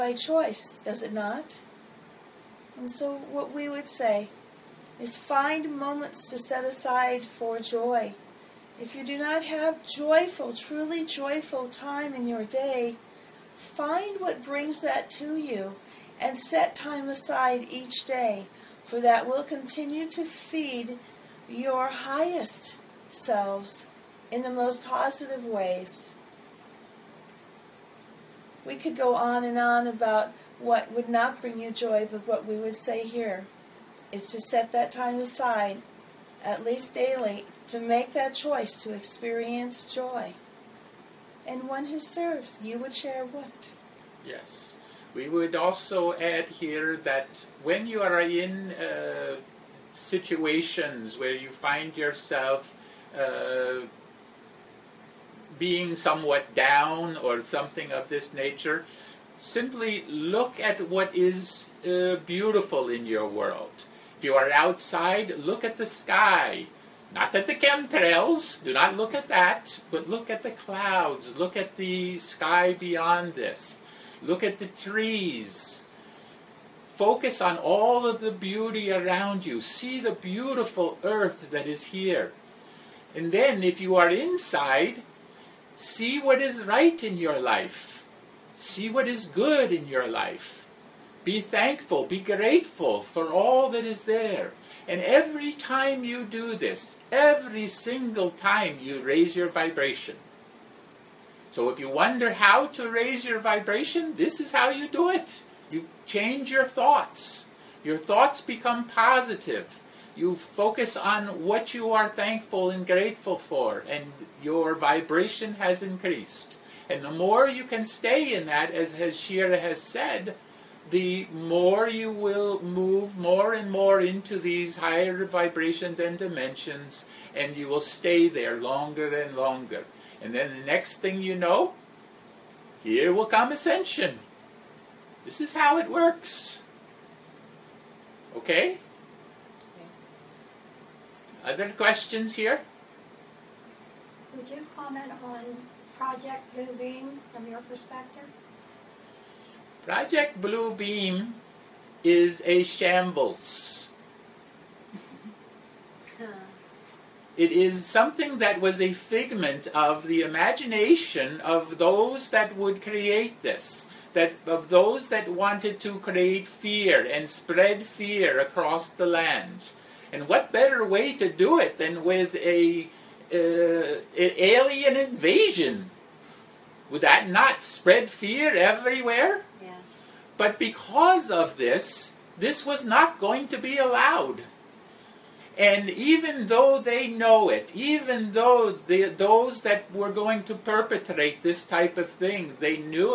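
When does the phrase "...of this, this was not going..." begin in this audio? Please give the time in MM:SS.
03:01.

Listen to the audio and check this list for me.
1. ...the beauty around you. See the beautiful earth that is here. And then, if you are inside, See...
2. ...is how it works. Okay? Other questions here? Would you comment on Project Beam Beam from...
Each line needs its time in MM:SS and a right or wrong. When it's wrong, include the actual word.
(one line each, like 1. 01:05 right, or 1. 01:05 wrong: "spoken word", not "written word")
1. 01:18 right
2. 02:15 wrong: "Blue", not "Beam".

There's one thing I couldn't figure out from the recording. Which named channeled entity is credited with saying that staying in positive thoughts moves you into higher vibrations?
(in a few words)
Ashira.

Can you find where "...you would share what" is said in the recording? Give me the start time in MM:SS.
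00:42.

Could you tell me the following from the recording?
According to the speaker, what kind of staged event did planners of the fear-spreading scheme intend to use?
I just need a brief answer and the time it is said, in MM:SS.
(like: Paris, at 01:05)
An alien invasion, at 02:54.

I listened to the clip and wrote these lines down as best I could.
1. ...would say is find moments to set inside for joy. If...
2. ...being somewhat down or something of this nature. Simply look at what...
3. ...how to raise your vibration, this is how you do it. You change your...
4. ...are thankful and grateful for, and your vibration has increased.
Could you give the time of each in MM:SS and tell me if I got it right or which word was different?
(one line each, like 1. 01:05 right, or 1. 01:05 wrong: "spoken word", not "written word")
1. 00:03 wrong: "aside", not "inside"
2. 00:55 right
3. 01:42 right
4. 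01:51 right.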